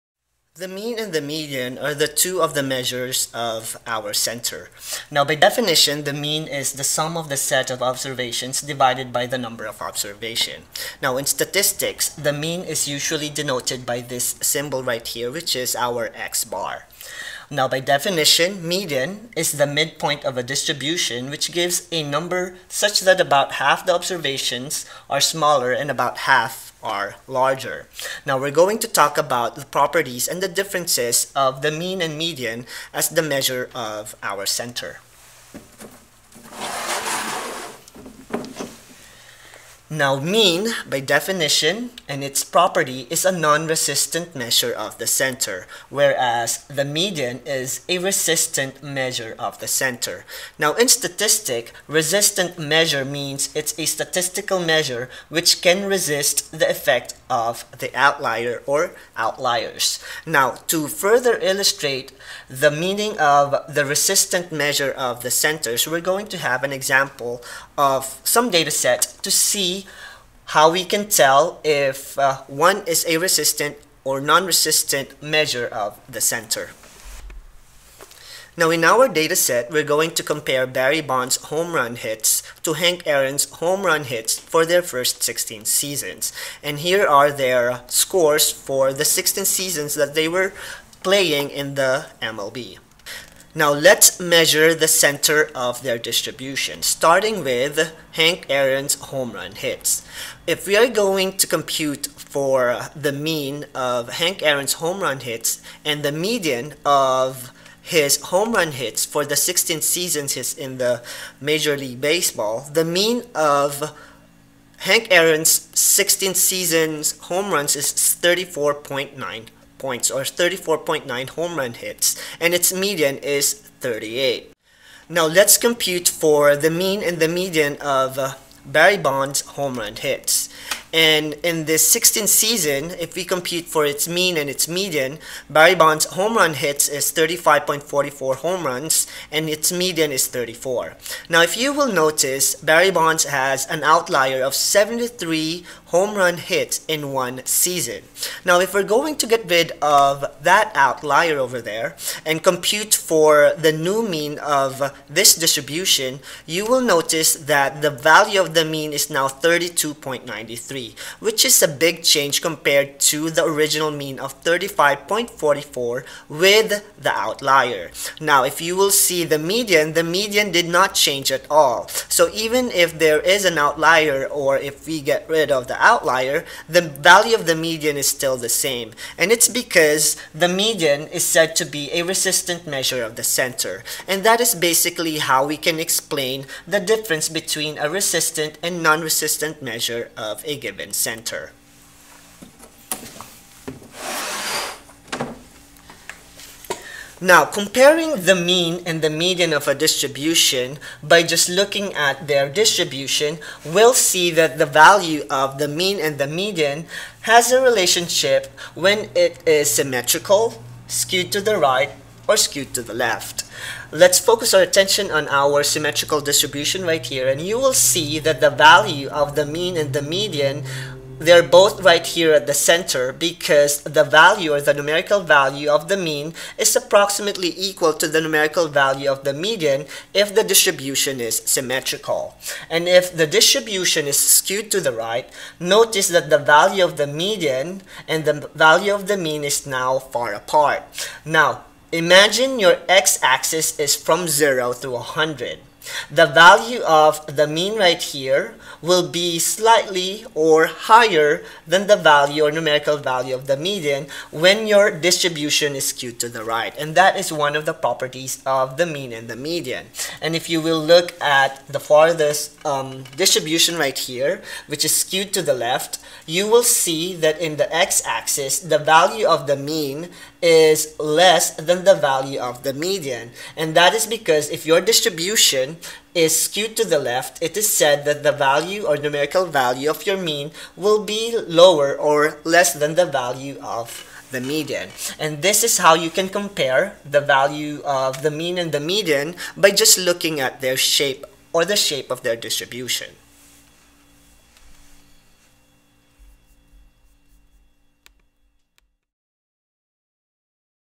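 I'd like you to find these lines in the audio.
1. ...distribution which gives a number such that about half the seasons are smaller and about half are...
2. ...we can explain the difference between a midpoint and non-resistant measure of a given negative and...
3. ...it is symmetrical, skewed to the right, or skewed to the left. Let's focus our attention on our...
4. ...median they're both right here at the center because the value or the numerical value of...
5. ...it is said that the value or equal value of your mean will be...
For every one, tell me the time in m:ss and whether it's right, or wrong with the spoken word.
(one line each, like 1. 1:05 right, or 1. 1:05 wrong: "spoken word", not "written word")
1. 0:20 wrong: "observations", not "seasons"
2. 3:05 wrong: "resistant", not "midpoint"
3. 3:29 right
4. 3:40 right
5. 4:37 wrong: "numerical", not "equal".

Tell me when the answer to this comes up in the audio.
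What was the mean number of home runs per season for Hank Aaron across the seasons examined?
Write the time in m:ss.
2:00.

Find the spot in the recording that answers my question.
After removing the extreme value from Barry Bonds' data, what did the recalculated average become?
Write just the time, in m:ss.
2:39.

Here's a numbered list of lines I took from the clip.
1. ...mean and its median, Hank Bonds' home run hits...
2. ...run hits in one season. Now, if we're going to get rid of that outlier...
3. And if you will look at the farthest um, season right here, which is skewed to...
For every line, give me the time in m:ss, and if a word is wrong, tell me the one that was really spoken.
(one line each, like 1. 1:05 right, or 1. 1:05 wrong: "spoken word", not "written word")
1. 2:14 wrong: "Barry", not "Hank"
2. 2:26 right
3. 4:20 wrong: "distribution", not "season".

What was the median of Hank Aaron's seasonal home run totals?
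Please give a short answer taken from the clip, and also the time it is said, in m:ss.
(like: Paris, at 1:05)
38, at 2:03.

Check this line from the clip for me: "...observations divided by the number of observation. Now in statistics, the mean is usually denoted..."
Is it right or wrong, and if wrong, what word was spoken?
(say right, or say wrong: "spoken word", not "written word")
right.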